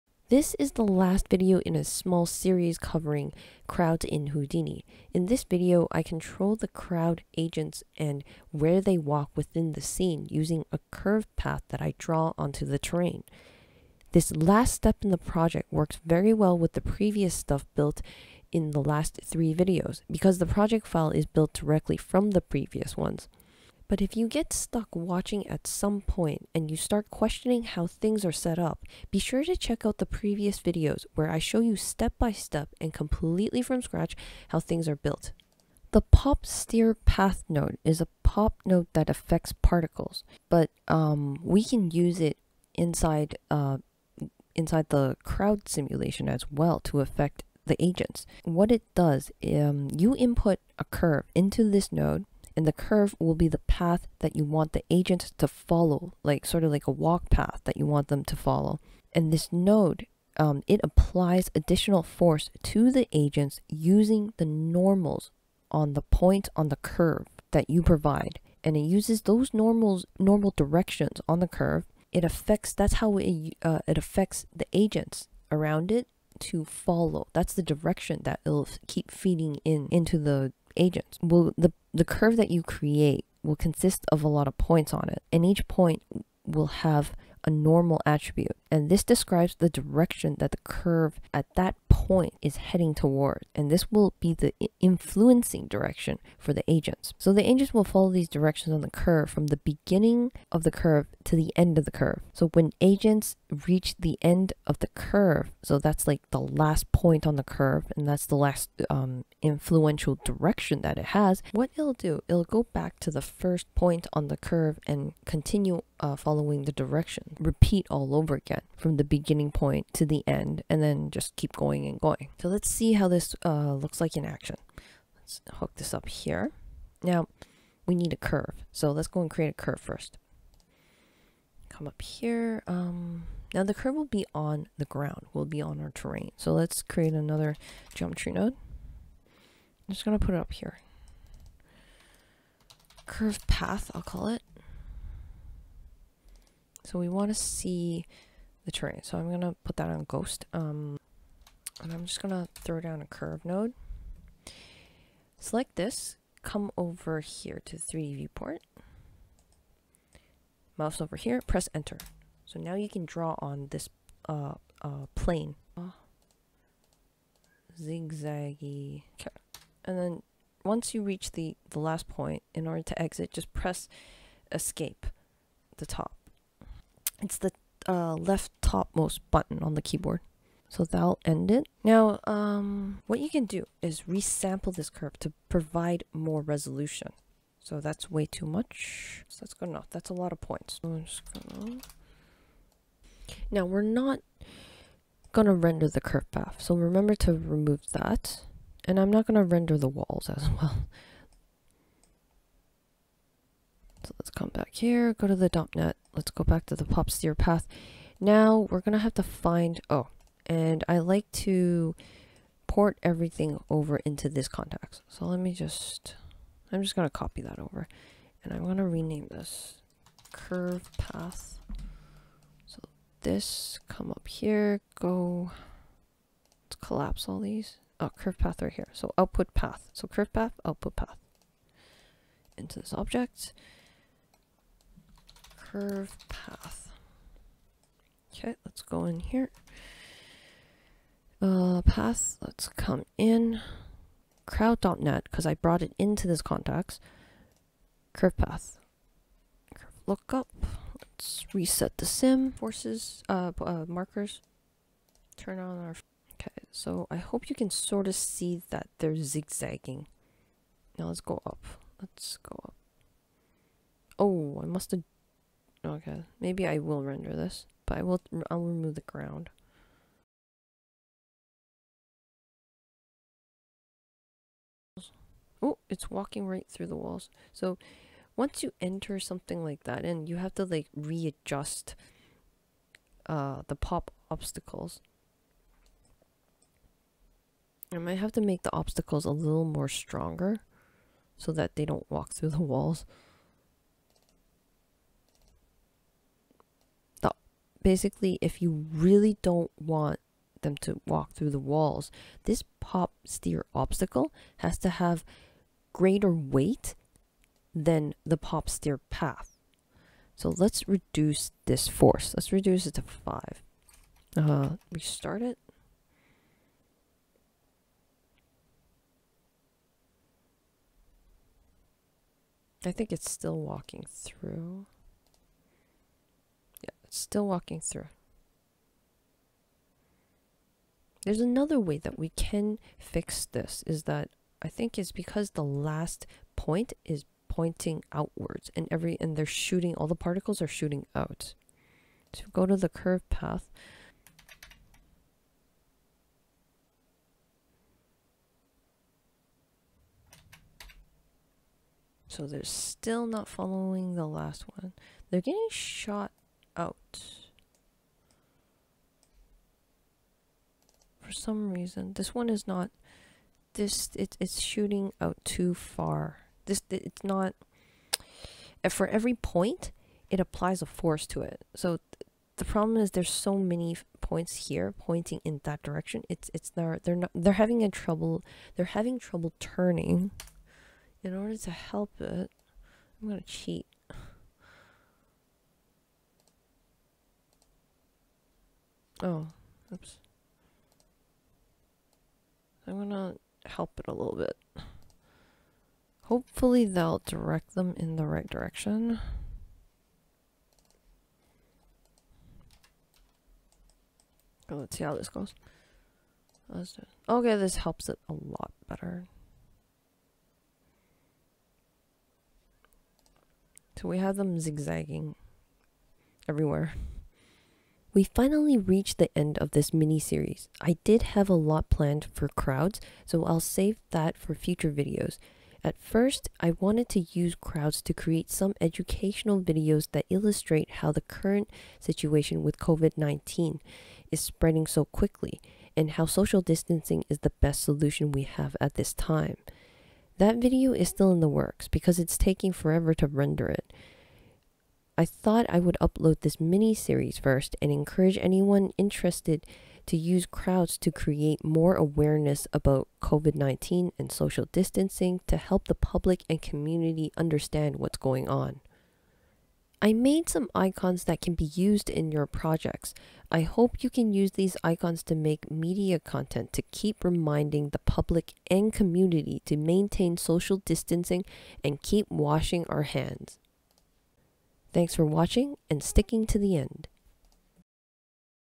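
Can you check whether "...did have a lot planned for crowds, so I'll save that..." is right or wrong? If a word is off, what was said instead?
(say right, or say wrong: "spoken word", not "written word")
right.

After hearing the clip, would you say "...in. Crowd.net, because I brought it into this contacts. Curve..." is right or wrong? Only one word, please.
right.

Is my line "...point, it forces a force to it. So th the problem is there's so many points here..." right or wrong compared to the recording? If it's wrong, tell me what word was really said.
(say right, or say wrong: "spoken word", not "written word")
wrong: "applies", not "forces".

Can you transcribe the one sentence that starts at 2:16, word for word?
So let's create another geometry node.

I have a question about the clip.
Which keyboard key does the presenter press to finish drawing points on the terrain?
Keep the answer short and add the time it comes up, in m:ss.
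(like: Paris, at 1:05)
escape, at 2:54.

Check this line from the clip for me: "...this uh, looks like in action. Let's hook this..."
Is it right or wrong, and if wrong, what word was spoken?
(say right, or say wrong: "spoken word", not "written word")
right.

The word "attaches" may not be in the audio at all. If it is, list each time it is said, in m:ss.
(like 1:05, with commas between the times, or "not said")
not said.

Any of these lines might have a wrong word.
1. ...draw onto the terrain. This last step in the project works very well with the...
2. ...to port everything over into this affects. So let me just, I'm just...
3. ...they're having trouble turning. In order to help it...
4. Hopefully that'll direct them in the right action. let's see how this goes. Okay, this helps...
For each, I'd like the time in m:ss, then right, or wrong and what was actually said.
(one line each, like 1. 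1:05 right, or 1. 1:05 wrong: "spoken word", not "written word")
1. 0:11 right
2. 3:31 wrong: "contacts", not "affects"
3. 6:18 right
4. 6:36 wrong: "direction", not "action".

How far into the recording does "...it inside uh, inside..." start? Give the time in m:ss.
0:42.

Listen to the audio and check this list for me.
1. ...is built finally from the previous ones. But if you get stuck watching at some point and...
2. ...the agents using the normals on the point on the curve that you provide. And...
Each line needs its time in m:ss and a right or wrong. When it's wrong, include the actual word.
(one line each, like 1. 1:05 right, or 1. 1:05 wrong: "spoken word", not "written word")
1. 0:21 wrong: "directly", not "finally"
2. 1:02 right.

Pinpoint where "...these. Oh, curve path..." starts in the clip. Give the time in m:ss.
3:47.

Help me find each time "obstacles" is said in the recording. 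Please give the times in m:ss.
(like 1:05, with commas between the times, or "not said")
4:44, 4:48, 5:03.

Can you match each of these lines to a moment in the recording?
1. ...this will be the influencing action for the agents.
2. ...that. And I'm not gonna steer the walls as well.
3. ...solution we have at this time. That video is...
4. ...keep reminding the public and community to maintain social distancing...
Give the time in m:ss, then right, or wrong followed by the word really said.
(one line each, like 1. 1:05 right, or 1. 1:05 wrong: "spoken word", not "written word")
1. 1:33 wrong: "direction", not "action"
2. 3:17 wrong: "render", not "steer"
3. 7:17 right
4. 7:46 right.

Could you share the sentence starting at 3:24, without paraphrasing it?
So let's come back here, go to the DOP net.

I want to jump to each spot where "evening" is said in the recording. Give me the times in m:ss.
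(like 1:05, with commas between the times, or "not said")
not said.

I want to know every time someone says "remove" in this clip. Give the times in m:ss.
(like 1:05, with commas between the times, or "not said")
3:17, 4:28.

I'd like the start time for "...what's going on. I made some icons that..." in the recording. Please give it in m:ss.
7:37.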